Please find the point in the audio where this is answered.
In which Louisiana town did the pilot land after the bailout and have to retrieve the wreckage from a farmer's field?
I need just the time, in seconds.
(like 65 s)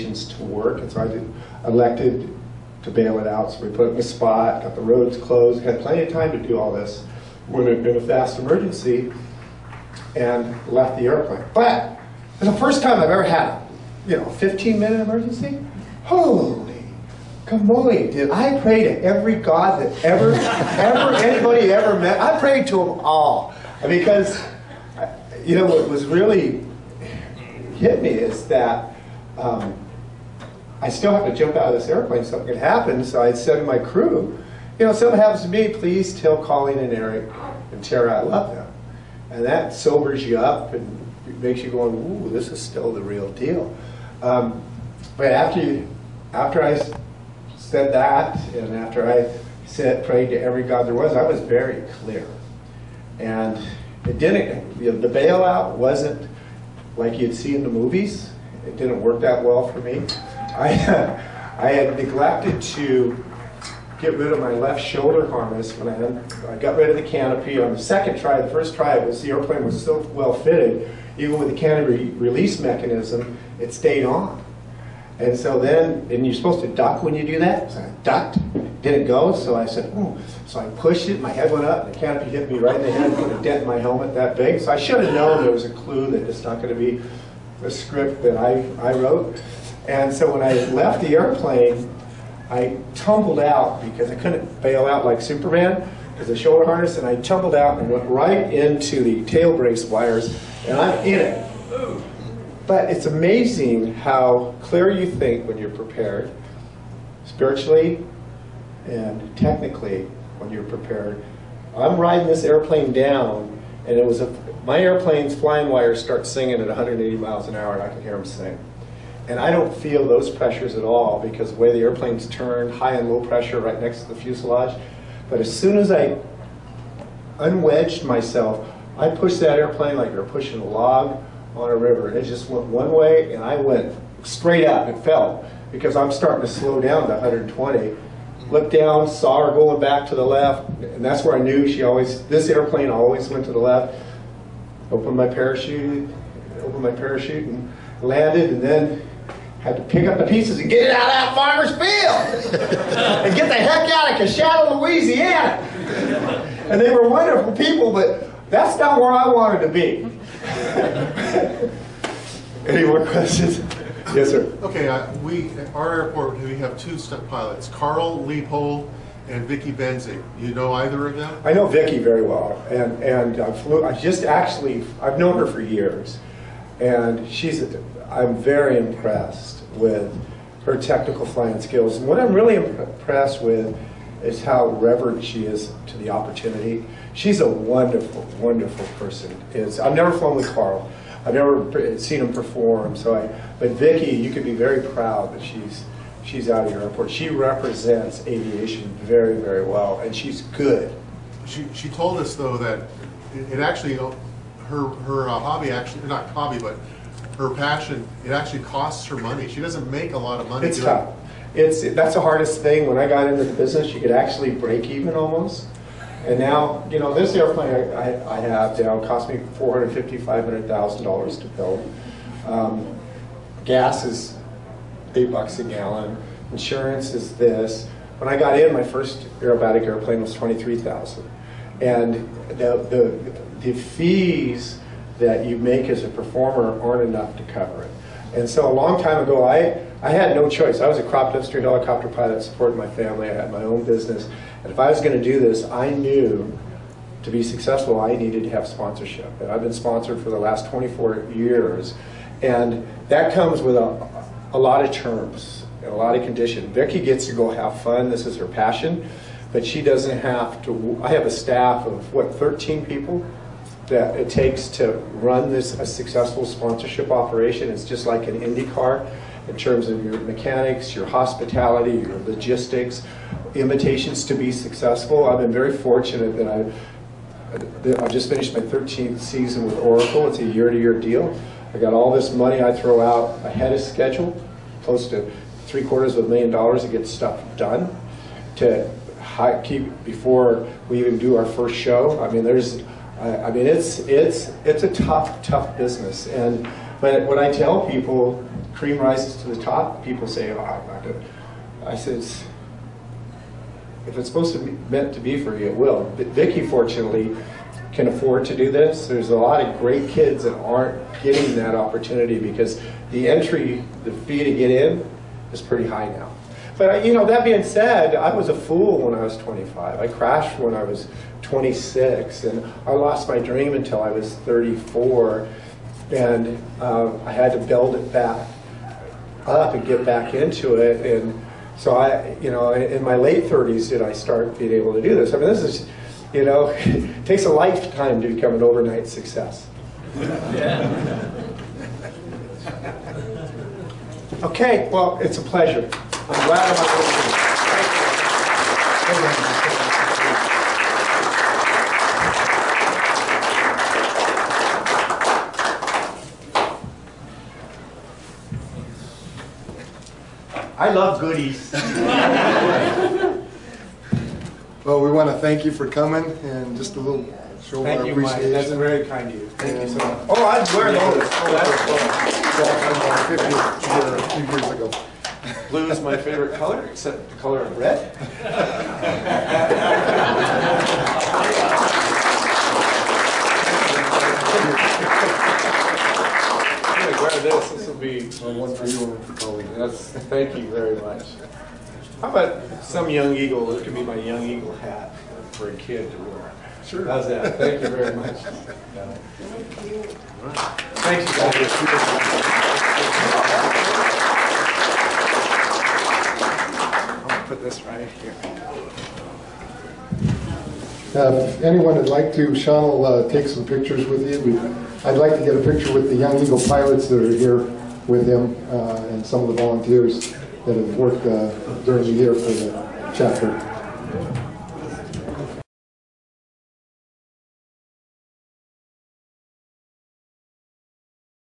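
154 s.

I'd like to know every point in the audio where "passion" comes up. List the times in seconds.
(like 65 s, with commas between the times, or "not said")
207 s, 258 s.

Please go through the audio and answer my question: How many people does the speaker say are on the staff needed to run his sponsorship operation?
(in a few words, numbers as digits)
13.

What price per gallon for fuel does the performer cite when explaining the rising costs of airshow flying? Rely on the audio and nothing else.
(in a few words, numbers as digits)
$8.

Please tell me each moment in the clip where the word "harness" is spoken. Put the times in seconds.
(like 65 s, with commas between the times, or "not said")
65 s, 96 s.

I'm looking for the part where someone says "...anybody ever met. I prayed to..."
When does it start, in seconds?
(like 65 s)
21 s.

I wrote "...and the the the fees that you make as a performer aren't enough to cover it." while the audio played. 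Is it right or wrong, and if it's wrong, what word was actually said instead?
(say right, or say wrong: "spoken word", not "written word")
right.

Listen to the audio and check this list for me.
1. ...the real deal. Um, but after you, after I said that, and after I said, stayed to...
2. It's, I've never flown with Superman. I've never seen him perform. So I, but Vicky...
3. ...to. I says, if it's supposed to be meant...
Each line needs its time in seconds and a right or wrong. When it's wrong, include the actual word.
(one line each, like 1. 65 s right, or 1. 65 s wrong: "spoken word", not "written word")
1. 42 s wrong: "prayed", not "stayed"
2. 189 s wrong: "Carl", not "Superman"
3. 301 s right.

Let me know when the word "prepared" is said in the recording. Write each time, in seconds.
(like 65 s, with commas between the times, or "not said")
105 s, 110 s.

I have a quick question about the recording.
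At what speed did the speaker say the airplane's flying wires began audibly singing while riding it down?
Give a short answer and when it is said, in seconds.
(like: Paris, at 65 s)
180 miles an hour, at 116 s.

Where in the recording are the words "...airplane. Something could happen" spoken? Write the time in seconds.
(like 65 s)
31 s.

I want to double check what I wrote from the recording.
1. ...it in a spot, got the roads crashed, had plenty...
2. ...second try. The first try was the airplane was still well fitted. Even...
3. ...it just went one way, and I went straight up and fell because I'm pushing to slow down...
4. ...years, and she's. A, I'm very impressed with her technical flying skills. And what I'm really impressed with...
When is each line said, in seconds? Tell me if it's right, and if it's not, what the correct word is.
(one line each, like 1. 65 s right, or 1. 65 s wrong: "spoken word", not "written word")
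1. 3 s wrong: "closed", not "crashed"
2. 67 s right
3. 132 s wrong: "starting", not "pushing"
4. 175 s right.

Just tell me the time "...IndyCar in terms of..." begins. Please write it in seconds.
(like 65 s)
268 s.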